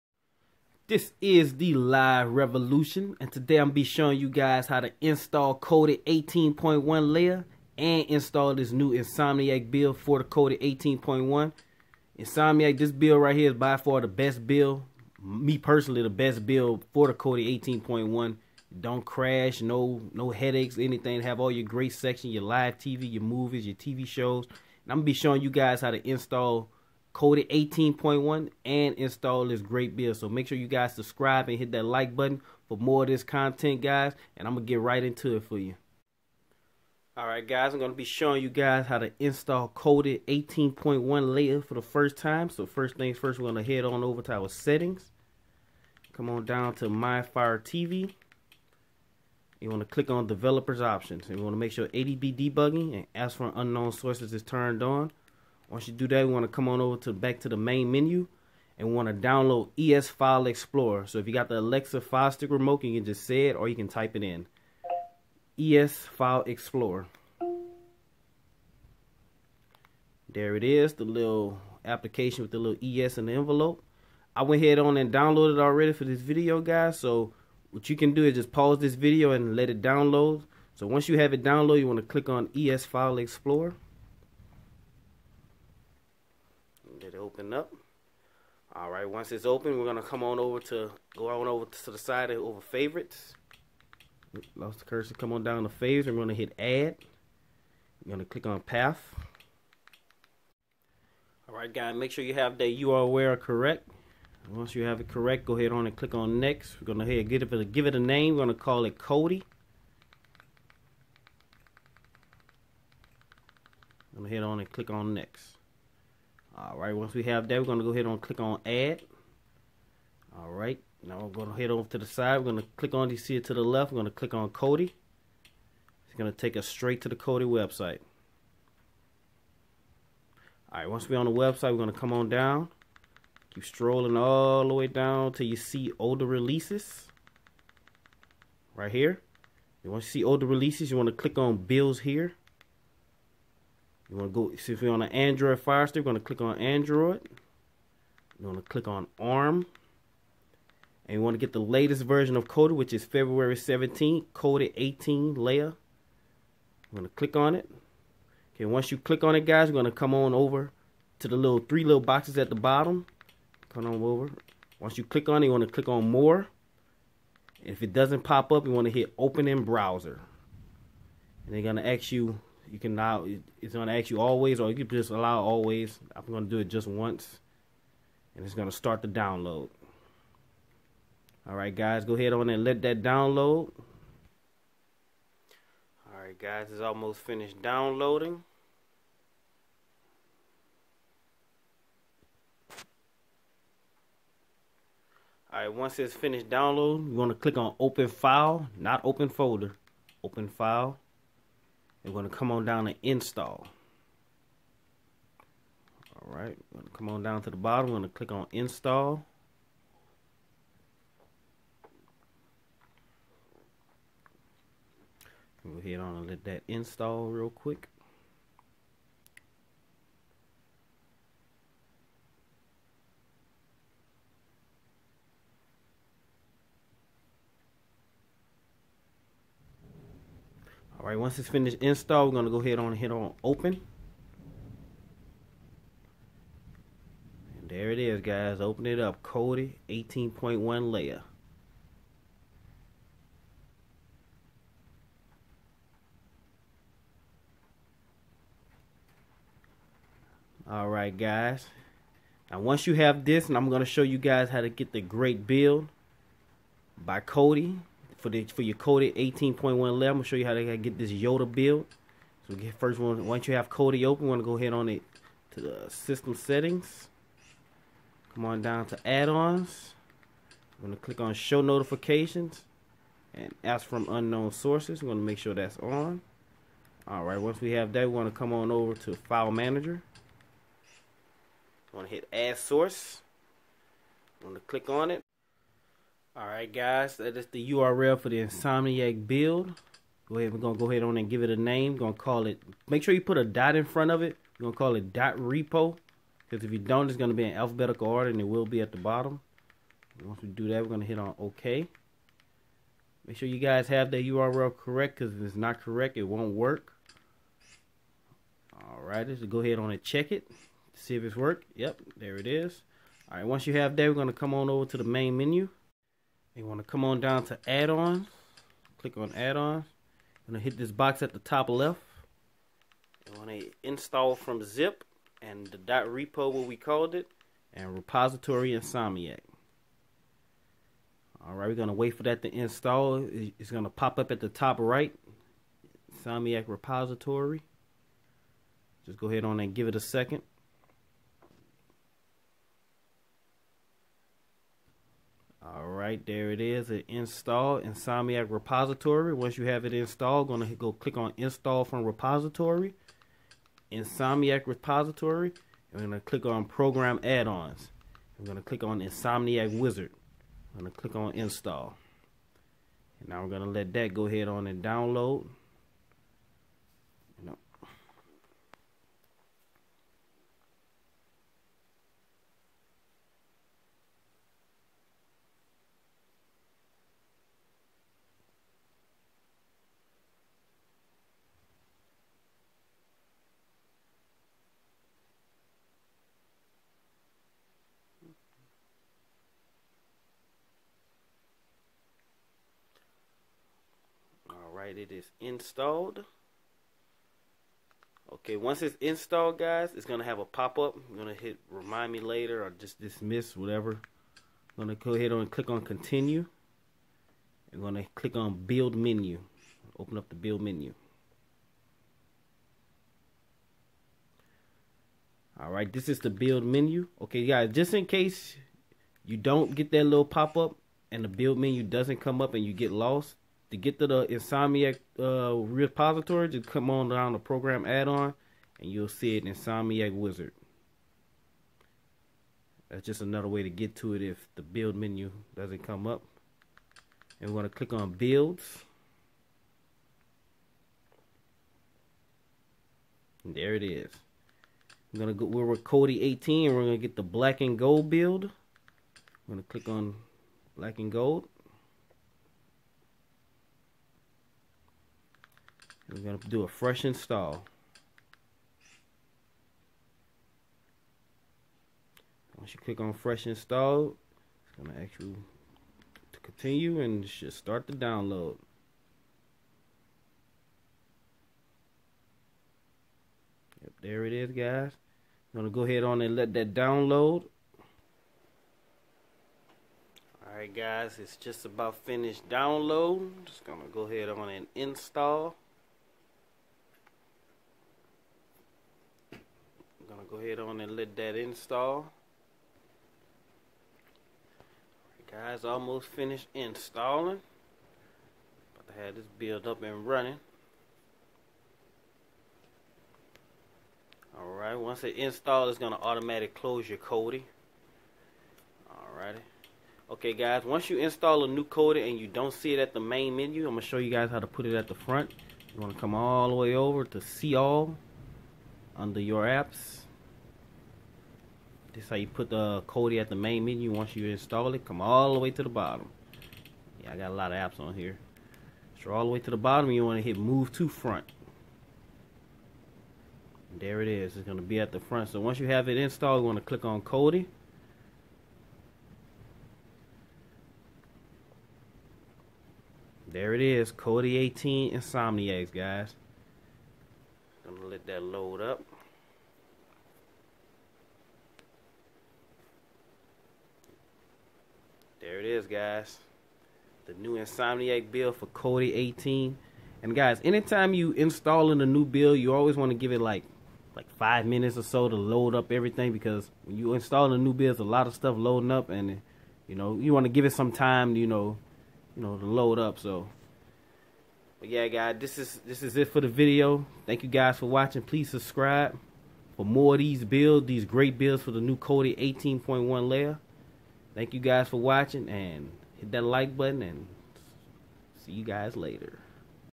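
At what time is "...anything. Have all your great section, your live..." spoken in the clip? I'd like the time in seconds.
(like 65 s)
20 s.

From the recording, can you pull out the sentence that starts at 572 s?
So, but yeah, guys, this is this is it for the video.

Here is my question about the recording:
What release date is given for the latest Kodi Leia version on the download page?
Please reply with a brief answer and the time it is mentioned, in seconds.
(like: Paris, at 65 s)
February 17, at 153 s.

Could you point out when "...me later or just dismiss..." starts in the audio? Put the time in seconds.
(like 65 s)
402 s.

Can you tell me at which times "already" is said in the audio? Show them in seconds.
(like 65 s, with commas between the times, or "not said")
75 s.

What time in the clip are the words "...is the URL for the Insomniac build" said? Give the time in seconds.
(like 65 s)
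287 s.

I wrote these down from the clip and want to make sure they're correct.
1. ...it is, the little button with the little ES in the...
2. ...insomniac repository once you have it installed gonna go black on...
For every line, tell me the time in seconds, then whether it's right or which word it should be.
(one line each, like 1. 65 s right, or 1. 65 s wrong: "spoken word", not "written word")
1. 70 s wrong: "application", not "button"
2. 347 s wrong: "click", not "black".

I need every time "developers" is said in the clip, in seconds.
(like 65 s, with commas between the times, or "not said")
50 s.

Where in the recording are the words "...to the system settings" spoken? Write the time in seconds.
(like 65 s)
265 s.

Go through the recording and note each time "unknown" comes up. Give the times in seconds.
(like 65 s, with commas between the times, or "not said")
53 s, 274 s.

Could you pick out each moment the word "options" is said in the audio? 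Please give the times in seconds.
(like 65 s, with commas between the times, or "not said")
50 s.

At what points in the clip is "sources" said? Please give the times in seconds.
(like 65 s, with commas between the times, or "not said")
53 s, 274 s, 282 s.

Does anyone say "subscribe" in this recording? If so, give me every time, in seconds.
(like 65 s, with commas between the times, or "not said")
30 s, 578 s.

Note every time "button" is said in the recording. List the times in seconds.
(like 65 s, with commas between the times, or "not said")
32 s, 586 s.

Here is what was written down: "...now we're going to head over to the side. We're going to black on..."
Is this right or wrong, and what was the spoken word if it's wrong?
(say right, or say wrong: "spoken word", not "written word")
wrong: "click", not "black".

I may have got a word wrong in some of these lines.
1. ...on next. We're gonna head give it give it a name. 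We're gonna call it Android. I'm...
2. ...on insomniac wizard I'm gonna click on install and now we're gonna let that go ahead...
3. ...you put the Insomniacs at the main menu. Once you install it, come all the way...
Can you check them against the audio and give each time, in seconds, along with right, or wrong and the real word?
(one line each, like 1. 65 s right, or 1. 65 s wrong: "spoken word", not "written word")
1. 106 s wrong: "Kodi", not "Android"
2. 358 s right
3. 522 s wrong: "Kodi", not "Insomniacs".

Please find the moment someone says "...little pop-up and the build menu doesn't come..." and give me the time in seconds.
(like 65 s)
420 s.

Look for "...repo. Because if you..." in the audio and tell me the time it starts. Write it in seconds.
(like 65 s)
295 s.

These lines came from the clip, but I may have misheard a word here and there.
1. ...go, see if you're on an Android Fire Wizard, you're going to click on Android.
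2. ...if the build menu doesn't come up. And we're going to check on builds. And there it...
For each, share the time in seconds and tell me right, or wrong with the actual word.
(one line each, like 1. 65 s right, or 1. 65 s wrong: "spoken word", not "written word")
1. 144 s wrong: "Stick", not "Wizard"
2. 434 s wrong: "click", not "check".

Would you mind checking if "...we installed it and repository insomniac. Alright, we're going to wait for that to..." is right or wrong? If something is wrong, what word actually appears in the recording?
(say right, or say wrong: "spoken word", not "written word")
wrong: "called", not "installed".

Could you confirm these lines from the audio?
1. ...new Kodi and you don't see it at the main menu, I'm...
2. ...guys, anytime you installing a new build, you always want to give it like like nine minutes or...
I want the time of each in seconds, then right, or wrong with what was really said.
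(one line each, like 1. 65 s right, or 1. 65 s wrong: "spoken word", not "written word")
1. 511 s right
2. 560 s wrong: "five", not "nine".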